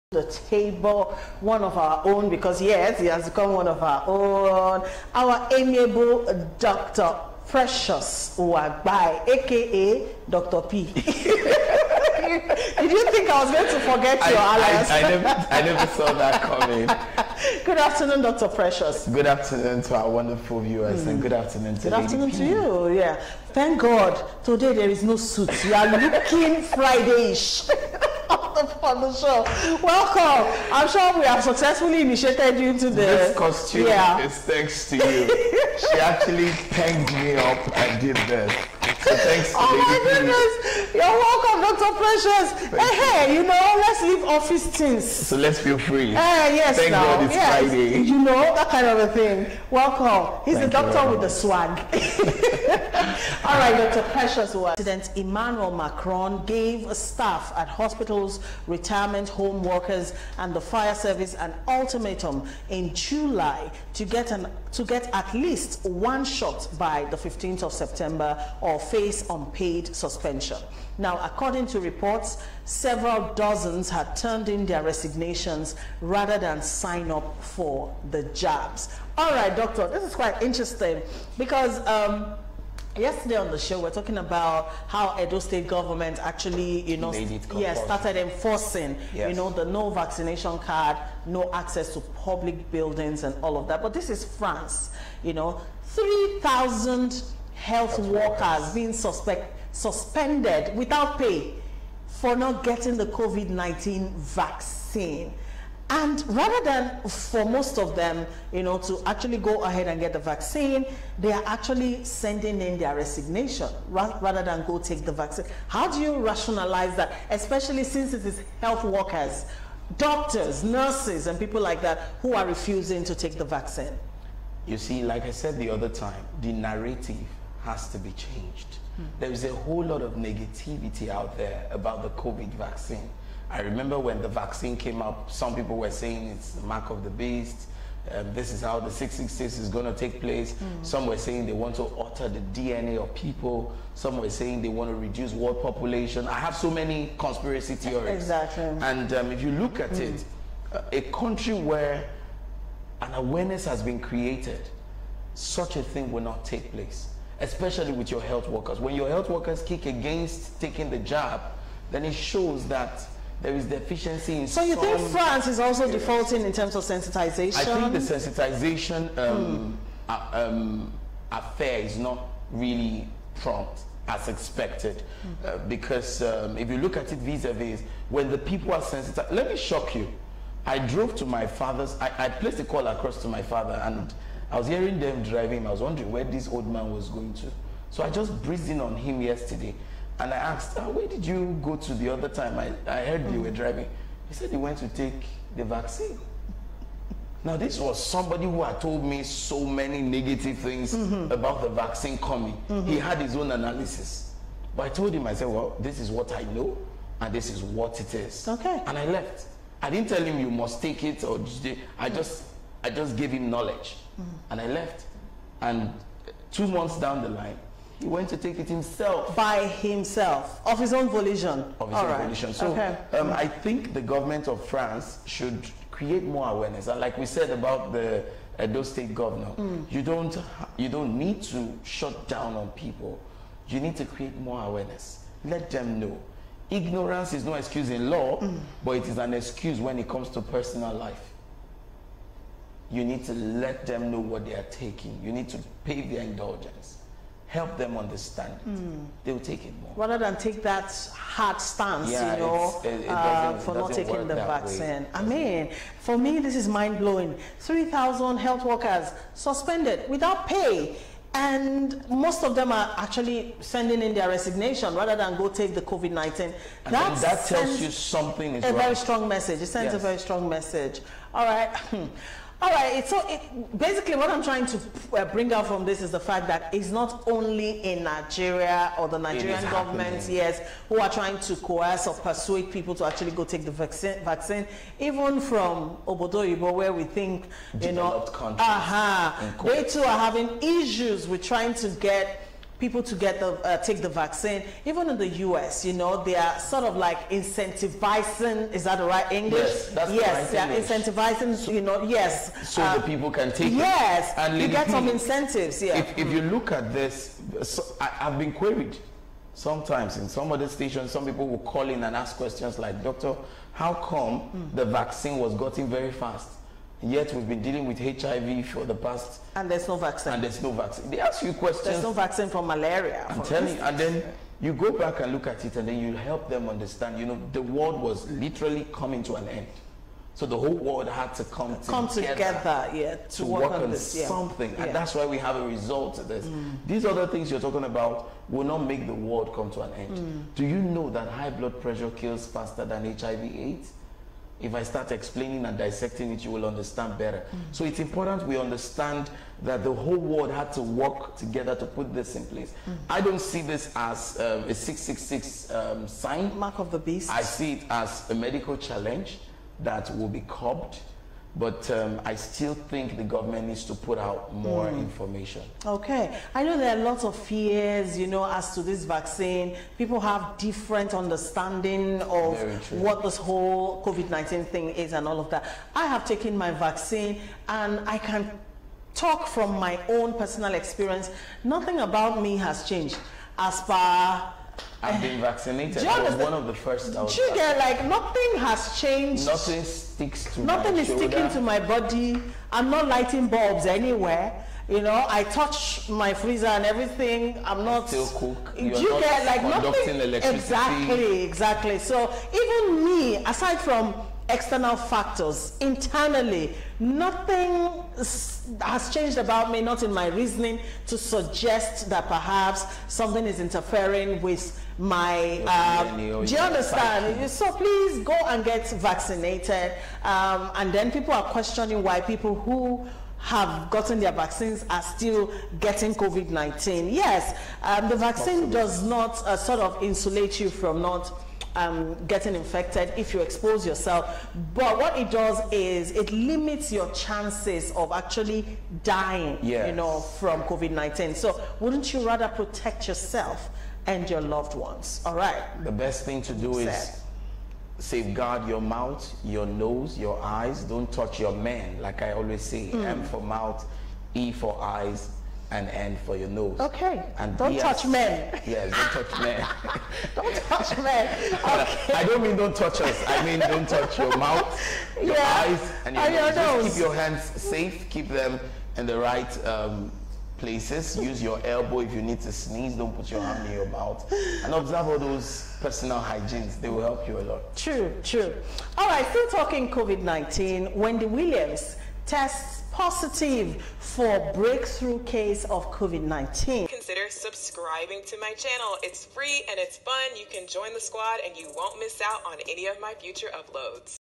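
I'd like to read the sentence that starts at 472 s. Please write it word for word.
Don't put your hand in your mouth.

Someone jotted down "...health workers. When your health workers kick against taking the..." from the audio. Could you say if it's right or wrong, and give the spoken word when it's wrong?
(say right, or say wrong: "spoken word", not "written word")
right.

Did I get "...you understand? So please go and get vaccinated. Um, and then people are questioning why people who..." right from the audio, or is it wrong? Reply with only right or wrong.
right.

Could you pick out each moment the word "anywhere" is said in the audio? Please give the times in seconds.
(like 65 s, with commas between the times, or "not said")
393 s.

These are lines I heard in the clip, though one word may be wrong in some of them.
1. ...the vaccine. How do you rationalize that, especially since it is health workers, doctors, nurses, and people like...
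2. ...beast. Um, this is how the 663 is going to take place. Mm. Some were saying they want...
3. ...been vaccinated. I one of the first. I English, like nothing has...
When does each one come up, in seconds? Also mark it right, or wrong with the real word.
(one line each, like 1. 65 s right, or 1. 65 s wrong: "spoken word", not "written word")
1. 115 s right
2. 137 s wrong: "666", not "663"
3. 385 s wrong: "Trigger", not "English".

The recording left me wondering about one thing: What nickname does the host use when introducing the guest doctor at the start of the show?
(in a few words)
Dr P.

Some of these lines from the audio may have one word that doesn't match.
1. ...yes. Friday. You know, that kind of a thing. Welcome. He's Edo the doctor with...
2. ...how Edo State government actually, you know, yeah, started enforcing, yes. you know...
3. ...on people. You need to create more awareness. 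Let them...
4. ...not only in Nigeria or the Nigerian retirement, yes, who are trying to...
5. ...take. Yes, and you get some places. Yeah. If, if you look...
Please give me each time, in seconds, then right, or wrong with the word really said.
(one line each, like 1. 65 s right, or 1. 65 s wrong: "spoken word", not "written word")
1. 47 s wrong: "Thank", not "Edo"
2. 84 s right
3. 232 s right
4. 276 s wrong: "government", not "retirement"
5. 303 s wrong: "incentives", not "places".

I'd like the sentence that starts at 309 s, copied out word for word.
Sometimes in some other stations, some people will call in and ask questions like, "Doctor, how come mm.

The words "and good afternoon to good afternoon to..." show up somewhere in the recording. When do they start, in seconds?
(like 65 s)
21 s.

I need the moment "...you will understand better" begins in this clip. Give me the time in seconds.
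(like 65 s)
346 s.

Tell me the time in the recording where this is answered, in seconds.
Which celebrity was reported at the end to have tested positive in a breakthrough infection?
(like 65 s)
480 s.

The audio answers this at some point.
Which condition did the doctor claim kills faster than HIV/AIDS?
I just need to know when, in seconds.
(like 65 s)
341 s.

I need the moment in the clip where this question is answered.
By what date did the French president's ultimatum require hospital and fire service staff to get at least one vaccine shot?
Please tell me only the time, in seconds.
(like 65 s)
67 s.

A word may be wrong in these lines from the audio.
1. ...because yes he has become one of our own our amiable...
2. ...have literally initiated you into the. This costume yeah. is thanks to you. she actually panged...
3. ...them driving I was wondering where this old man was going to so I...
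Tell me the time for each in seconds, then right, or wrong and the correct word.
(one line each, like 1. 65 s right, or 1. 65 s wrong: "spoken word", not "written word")
1. 2 s right
2. 31 s wrong: "successfully", not "literally"
3. 184 s right.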